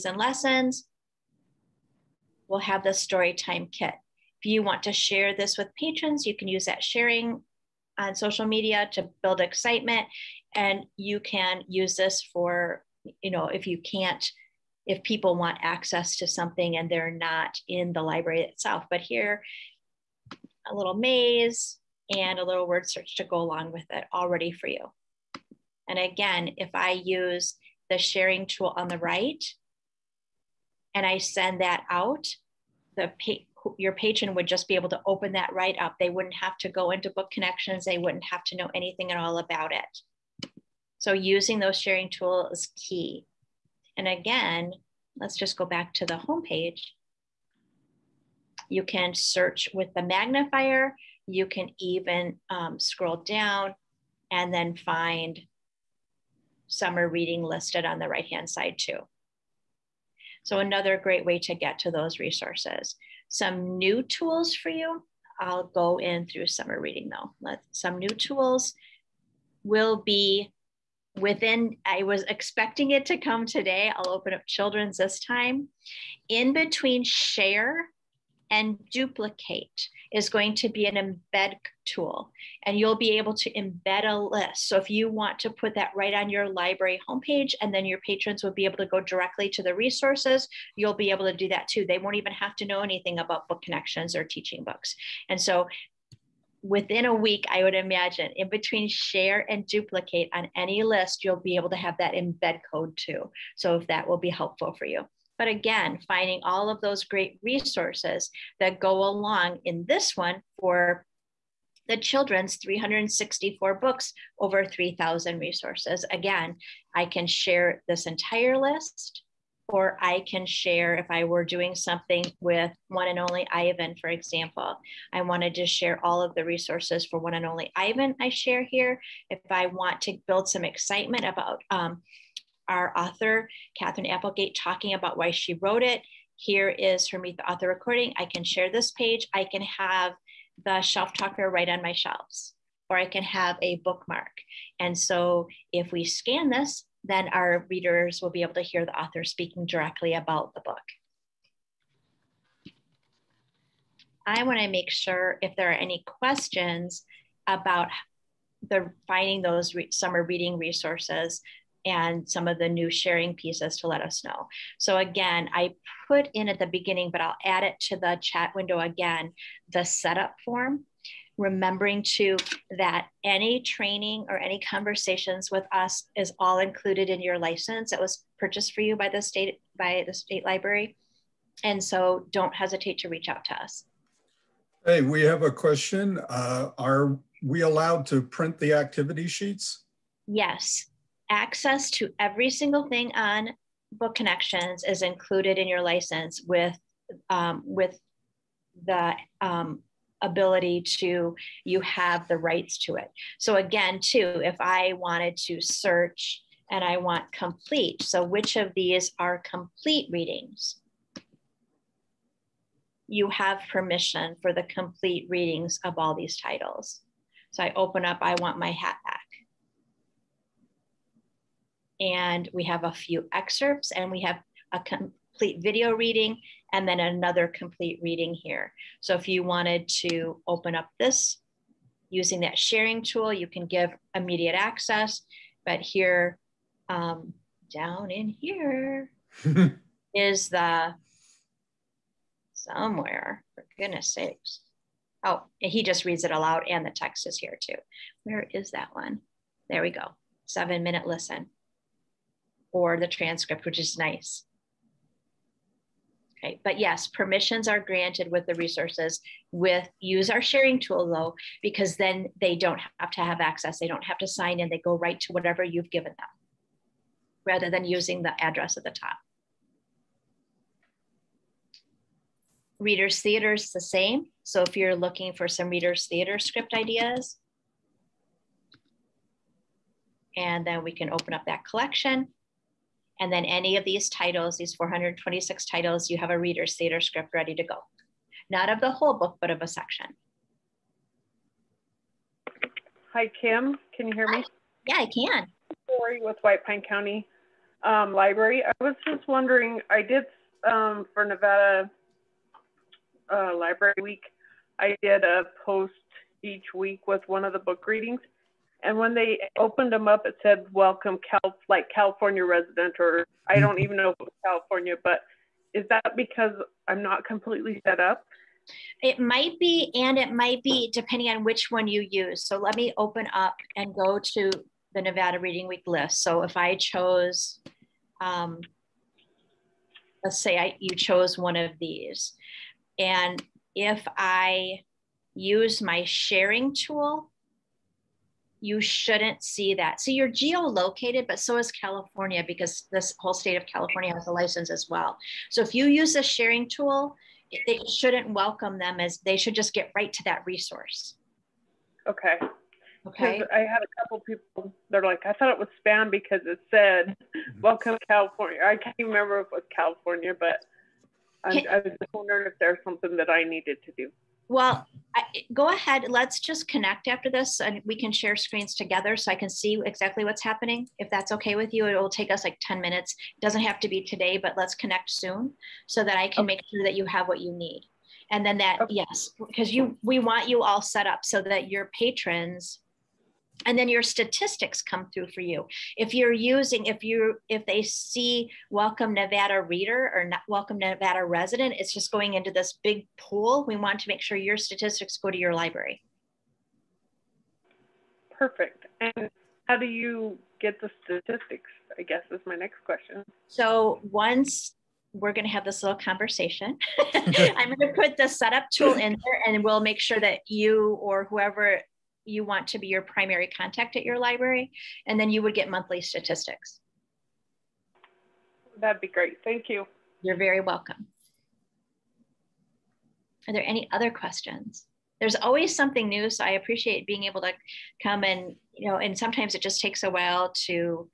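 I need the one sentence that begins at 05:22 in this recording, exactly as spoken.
So let me open up and go to the Nevada Reading Week list.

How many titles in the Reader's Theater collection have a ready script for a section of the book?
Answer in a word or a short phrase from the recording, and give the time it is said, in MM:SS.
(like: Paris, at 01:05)
426, at 04:44.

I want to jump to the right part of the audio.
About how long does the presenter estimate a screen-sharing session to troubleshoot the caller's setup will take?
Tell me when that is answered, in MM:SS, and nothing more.
06:12.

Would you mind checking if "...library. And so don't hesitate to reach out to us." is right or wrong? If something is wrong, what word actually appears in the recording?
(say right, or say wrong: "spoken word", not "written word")
right.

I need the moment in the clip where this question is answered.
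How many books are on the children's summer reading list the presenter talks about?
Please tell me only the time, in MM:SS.
01:52.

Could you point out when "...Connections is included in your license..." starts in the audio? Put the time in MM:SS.
03:14.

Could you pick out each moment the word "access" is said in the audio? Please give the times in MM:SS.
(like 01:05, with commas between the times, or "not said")
00:15, 03:11, 03:54, 04:23.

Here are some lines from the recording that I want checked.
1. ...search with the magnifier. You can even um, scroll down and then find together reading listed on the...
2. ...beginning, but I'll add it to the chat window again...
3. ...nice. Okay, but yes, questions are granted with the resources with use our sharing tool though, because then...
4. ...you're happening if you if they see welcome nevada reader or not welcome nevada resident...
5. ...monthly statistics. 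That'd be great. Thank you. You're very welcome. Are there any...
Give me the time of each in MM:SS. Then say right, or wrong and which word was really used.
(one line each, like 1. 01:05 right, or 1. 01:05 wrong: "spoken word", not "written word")
1. 00:49 wrong: "summer", not "together"
2. 02:46 right
3. 04:13 wrong: "permissions", not "questions"
4. 06:26 wrong: "using", not "happening"
5. 06:55 right.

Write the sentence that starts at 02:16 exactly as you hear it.
Here is her Meet the Author recording.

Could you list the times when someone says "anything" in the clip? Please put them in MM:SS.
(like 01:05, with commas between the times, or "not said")
00:38, 01:32.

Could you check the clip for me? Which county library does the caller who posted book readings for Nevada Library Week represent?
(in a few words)
White Pine County.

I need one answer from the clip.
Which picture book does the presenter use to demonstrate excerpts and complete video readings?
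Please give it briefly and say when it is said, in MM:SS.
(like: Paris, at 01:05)
I Want My Hat Back, at 03:38.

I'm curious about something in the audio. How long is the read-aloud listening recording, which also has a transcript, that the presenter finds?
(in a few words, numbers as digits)
7 minutes.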